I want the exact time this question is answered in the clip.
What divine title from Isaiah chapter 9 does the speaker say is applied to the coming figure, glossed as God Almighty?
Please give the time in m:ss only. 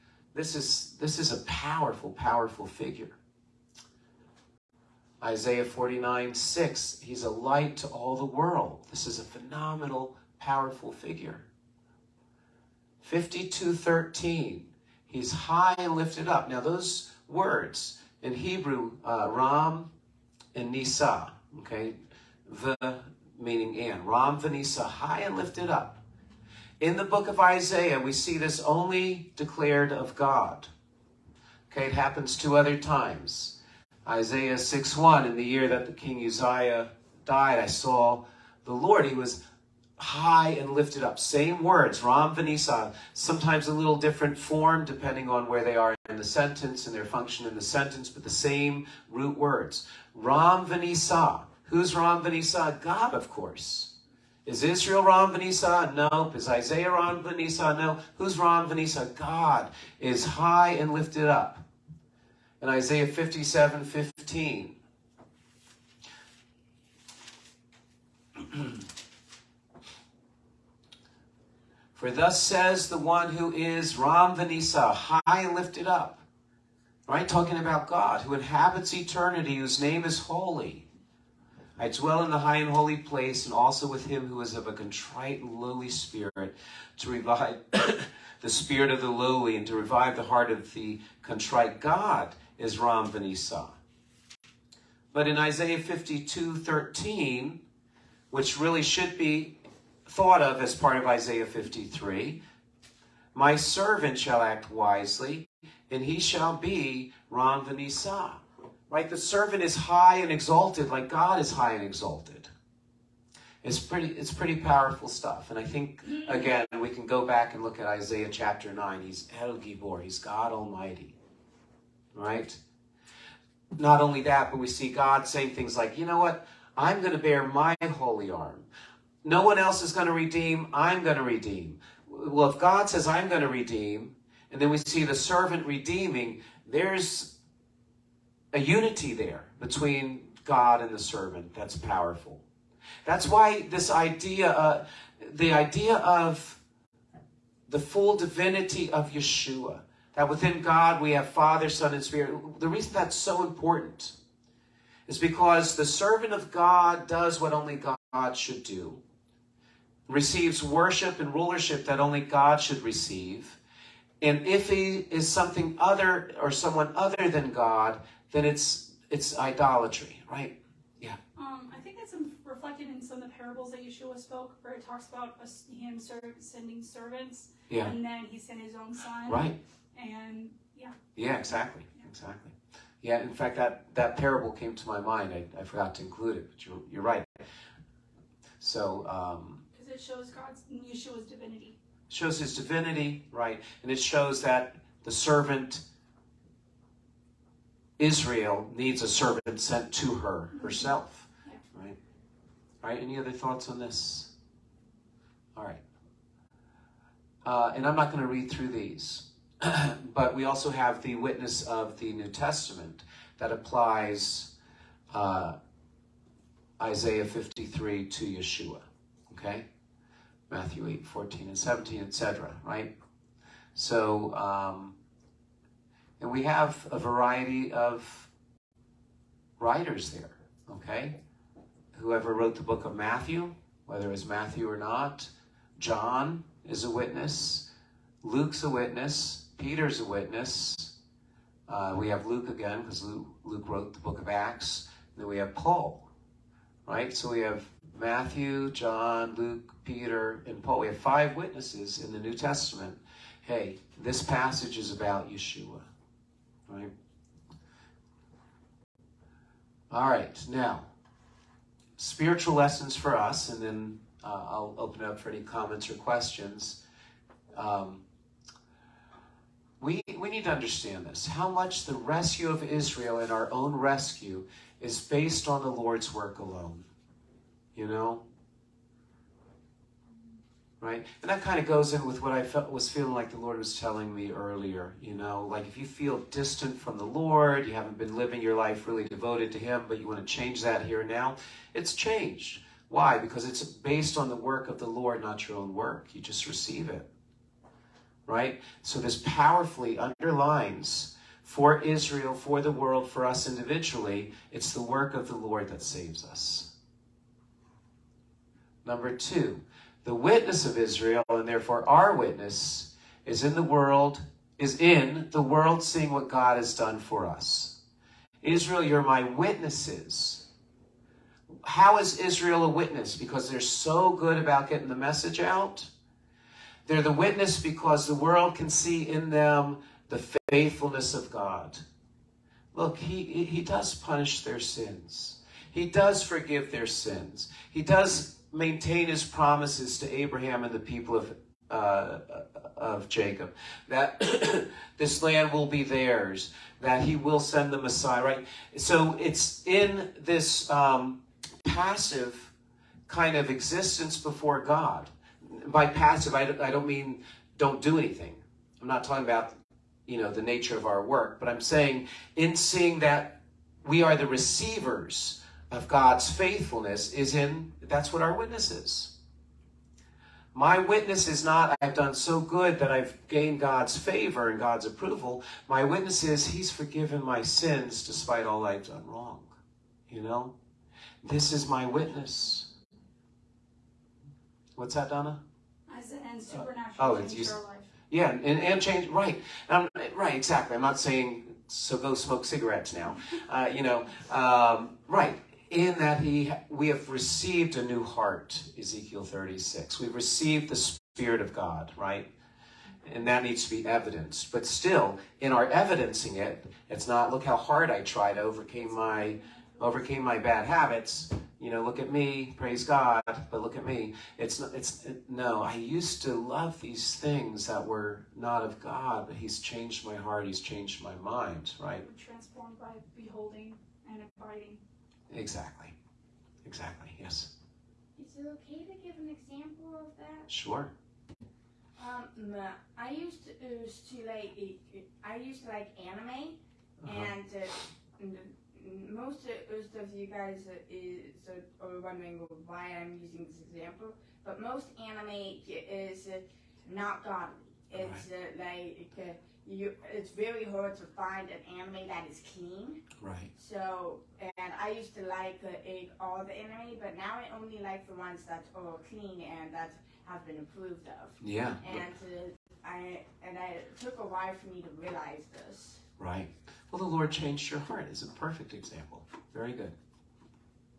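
1:59.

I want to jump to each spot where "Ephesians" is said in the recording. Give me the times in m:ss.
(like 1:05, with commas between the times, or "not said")
not said.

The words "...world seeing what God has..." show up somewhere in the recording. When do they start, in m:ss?
5:15.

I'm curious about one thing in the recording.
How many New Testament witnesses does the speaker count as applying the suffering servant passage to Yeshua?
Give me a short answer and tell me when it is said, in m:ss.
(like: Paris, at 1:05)
5, at 4:10.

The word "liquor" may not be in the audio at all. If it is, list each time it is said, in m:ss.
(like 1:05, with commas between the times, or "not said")
not said.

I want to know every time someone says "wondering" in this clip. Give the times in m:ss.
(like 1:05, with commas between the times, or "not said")
7:22.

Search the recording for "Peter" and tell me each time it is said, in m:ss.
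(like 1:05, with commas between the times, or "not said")
3:59, 4:09.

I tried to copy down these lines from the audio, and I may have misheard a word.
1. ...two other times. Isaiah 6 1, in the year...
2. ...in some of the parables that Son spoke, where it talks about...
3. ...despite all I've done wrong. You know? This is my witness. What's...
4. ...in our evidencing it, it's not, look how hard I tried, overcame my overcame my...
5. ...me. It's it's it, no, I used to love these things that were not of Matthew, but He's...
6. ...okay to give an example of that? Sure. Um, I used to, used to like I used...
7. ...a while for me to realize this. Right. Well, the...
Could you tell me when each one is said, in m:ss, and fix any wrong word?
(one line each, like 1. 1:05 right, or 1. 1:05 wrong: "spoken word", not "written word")
1. 0:32 right
2. 2:52 wrong: "Yeshua", not "Son"
3. 6:18 right
4. 6:45 right
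5. 6:53 wrong: "God", not "Matthew"
6. 7:08 right
7. 7:44 right.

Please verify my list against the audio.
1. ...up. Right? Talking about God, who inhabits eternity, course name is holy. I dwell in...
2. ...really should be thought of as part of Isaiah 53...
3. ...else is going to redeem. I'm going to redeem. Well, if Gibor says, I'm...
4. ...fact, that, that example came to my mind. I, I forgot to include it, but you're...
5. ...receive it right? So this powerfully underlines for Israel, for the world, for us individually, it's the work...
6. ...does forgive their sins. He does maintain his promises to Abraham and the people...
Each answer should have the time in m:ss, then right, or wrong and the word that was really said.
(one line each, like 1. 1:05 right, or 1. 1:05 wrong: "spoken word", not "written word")
1. 1:15 wrong: "whose", not "course"
2. 1:38 right
3. 2:09 wrong: "God", not "Gibor"
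4. 3:03 wrong: "parable", not "example"
5. 4:56 right
6. 5:35 right.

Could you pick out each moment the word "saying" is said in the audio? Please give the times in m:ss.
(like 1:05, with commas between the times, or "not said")
2:05, 6:01, 6:30.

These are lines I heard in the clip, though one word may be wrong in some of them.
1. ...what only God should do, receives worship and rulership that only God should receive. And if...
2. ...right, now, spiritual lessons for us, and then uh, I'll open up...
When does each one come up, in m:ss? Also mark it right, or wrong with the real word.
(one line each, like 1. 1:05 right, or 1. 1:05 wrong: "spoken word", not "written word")
1. 2:37 right
2. 4:20 right.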